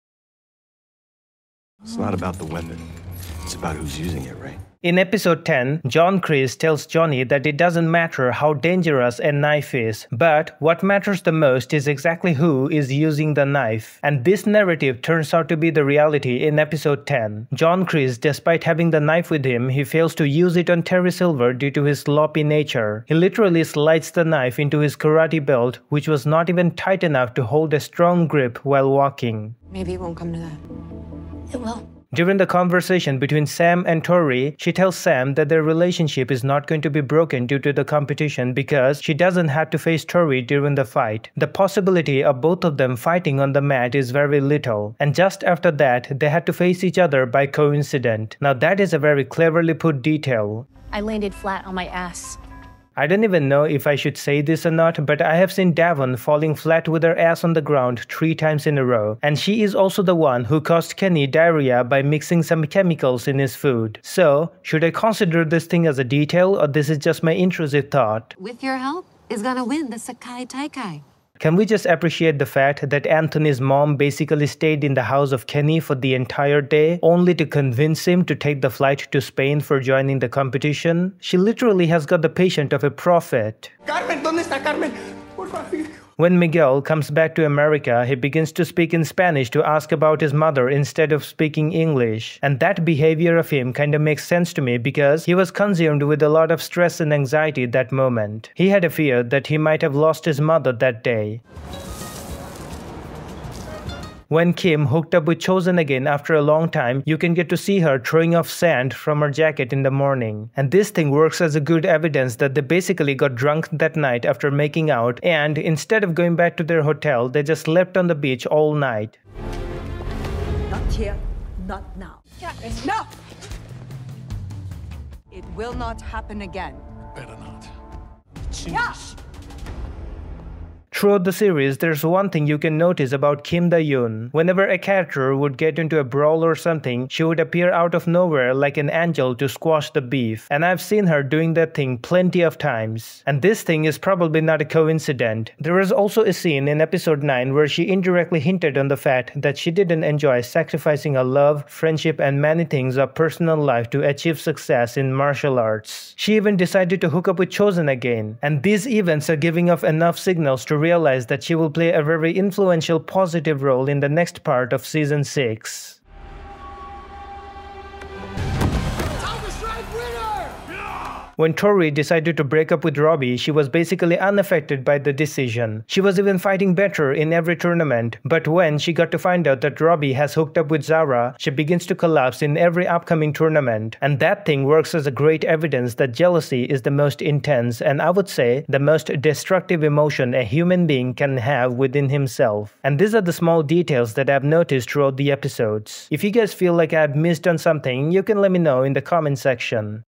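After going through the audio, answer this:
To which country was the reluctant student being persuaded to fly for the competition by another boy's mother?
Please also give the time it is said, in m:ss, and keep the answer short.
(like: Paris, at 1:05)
Spain, at 1:19.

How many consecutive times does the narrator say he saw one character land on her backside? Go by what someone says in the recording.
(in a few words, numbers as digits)
3.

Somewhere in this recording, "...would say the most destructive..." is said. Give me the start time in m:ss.
3:08.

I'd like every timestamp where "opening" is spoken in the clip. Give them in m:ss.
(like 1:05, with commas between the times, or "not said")
not said.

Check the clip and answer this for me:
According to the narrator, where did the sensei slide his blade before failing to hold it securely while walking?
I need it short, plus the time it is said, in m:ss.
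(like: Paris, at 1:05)
karate belt, at 0:24.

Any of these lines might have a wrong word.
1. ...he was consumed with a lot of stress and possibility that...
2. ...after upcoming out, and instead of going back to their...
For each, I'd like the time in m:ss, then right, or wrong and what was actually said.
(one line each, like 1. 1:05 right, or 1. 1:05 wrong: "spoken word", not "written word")
1. 1:35 wrong: "anxiety", not "possibility"
2. 1:54 wrong: "making", not "upcoming".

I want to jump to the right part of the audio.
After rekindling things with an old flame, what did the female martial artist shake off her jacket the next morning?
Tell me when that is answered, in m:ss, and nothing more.
1:48.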